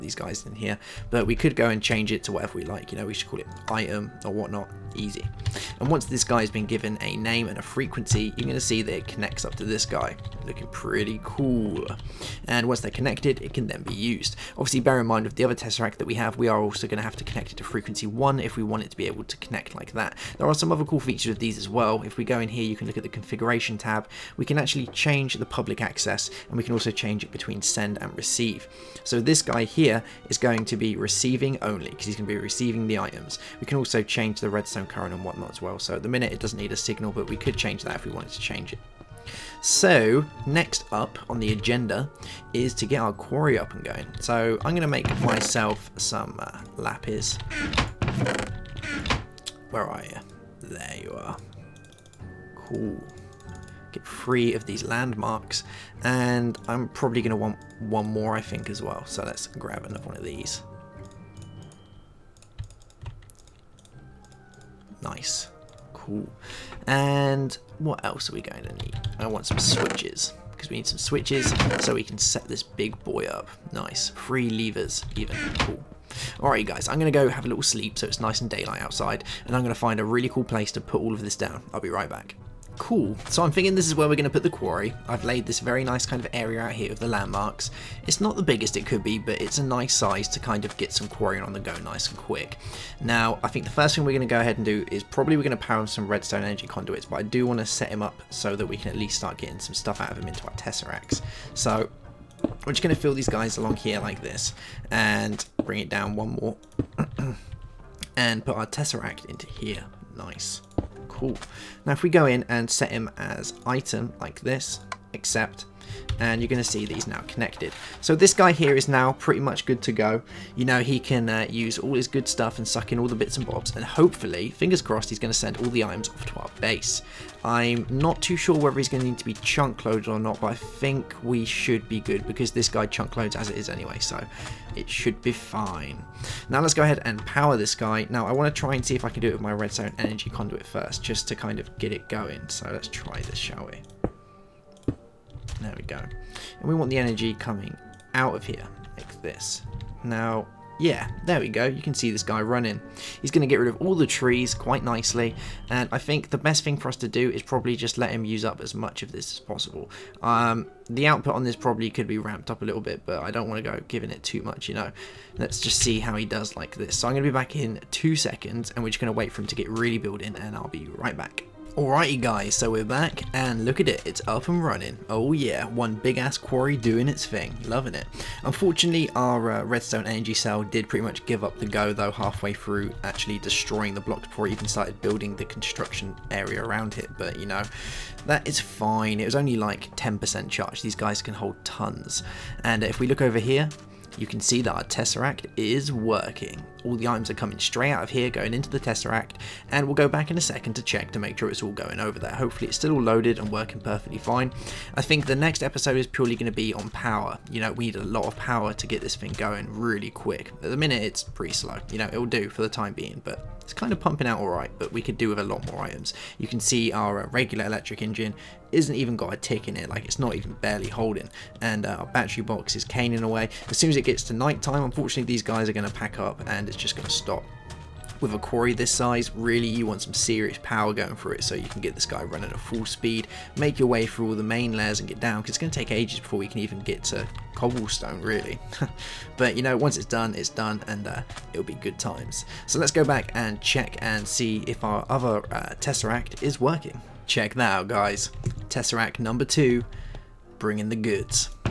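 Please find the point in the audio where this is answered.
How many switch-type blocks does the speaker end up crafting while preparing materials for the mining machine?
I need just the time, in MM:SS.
01:14.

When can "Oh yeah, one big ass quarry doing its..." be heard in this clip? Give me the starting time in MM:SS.
02:55.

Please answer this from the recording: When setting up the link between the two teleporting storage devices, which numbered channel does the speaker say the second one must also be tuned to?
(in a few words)
frequency 1.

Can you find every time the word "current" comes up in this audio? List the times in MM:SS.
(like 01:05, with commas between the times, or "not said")
00:34.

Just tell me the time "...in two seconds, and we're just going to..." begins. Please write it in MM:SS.
02:47.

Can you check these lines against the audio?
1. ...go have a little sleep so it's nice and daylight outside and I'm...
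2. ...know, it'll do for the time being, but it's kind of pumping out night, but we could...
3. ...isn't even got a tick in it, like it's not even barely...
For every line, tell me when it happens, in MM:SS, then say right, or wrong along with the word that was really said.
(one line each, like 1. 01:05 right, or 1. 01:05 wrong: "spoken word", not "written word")
1. 01:17 right
2. 03:31 wrong: "alright", not "night"
3. 03:38 right.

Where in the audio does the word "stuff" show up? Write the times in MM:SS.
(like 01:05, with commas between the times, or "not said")
01:39, 02:02.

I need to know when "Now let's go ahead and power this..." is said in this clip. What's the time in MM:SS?
02:16.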